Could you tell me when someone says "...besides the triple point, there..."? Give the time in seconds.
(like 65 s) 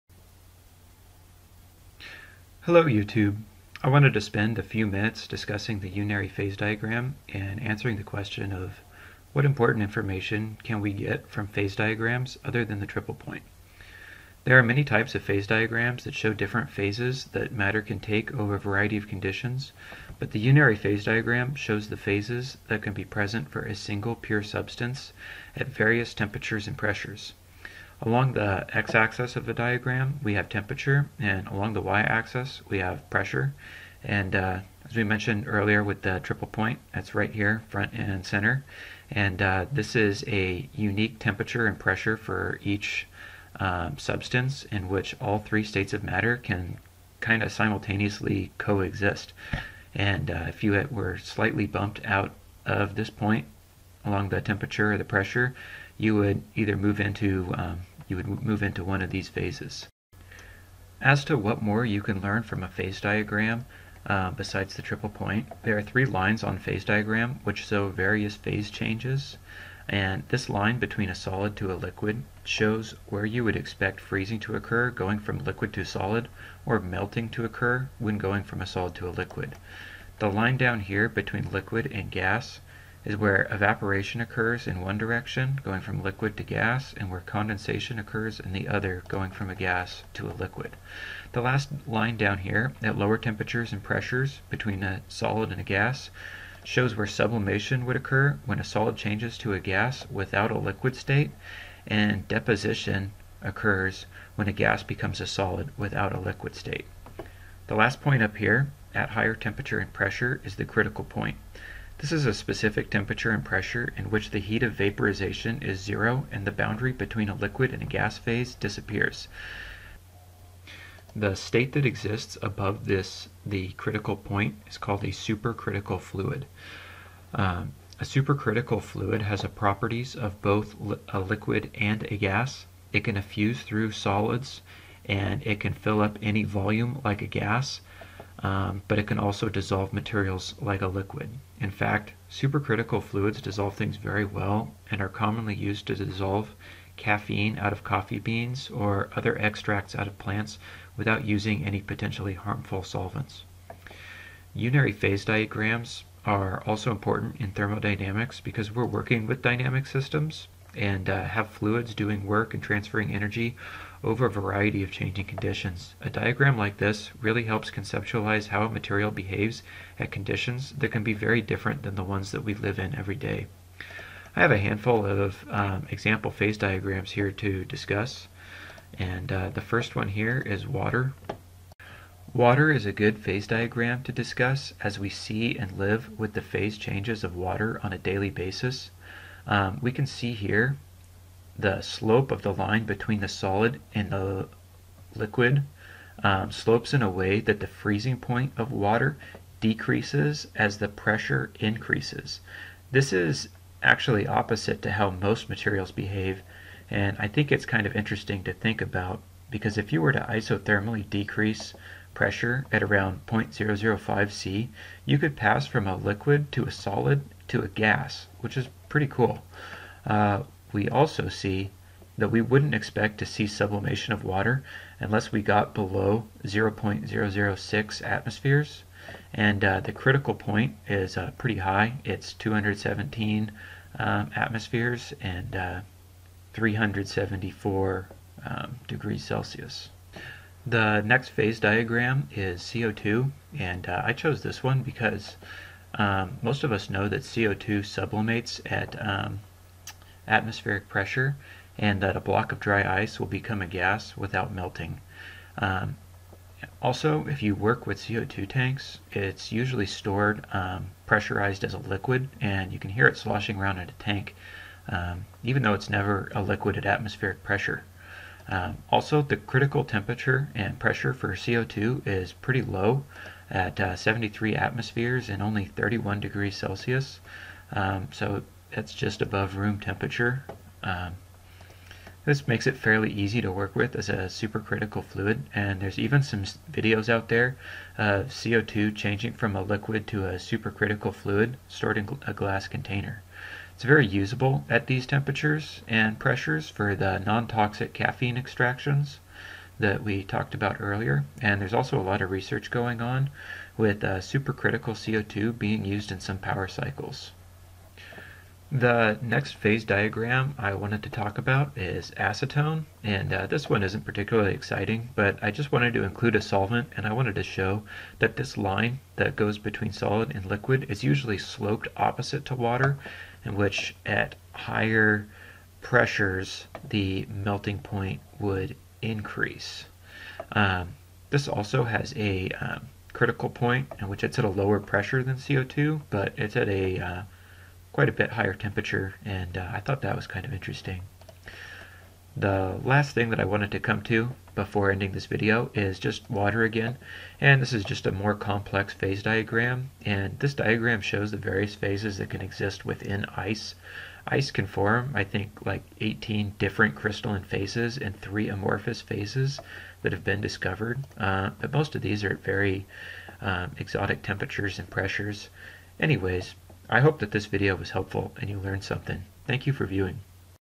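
64 s.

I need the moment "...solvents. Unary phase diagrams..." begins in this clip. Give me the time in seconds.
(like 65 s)
152 s.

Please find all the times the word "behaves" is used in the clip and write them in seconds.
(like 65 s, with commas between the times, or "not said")
169 s, 205 s.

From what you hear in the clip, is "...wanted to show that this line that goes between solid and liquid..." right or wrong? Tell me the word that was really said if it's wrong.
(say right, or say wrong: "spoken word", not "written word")
right.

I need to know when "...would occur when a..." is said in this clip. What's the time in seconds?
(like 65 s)
97 s.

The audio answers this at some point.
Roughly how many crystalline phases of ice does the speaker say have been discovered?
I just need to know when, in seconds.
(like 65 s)
355 s.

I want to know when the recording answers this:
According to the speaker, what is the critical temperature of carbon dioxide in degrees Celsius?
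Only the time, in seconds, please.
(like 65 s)
275 s.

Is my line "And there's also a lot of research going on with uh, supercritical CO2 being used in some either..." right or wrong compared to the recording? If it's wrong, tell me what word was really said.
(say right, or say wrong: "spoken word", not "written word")
wrong: "power", not "either".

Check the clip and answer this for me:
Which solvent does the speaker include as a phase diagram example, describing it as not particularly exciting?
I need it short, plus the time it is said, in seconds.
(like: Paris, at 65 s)
acetone, at 312 s.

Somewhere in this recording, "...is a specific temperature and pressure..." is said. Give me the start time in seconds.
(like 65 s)
112 s.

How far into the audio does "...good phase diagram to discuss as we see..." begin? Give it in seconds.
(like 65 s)
182 s.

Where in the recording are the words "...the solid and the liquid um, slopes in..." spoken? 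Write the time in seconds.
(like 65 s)
193 s.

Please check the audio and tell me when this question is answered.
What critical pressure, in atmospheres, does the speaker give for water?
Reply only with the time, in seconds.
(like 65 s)
232 s.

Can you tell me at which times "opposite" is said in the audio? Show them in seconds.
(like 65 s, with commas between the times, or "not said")
204 s, 321 s.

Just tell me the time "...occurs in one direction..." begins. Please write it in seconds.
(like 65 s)
84 s.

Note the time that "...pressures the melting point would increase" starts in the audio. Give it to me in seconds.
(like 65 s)
325 s.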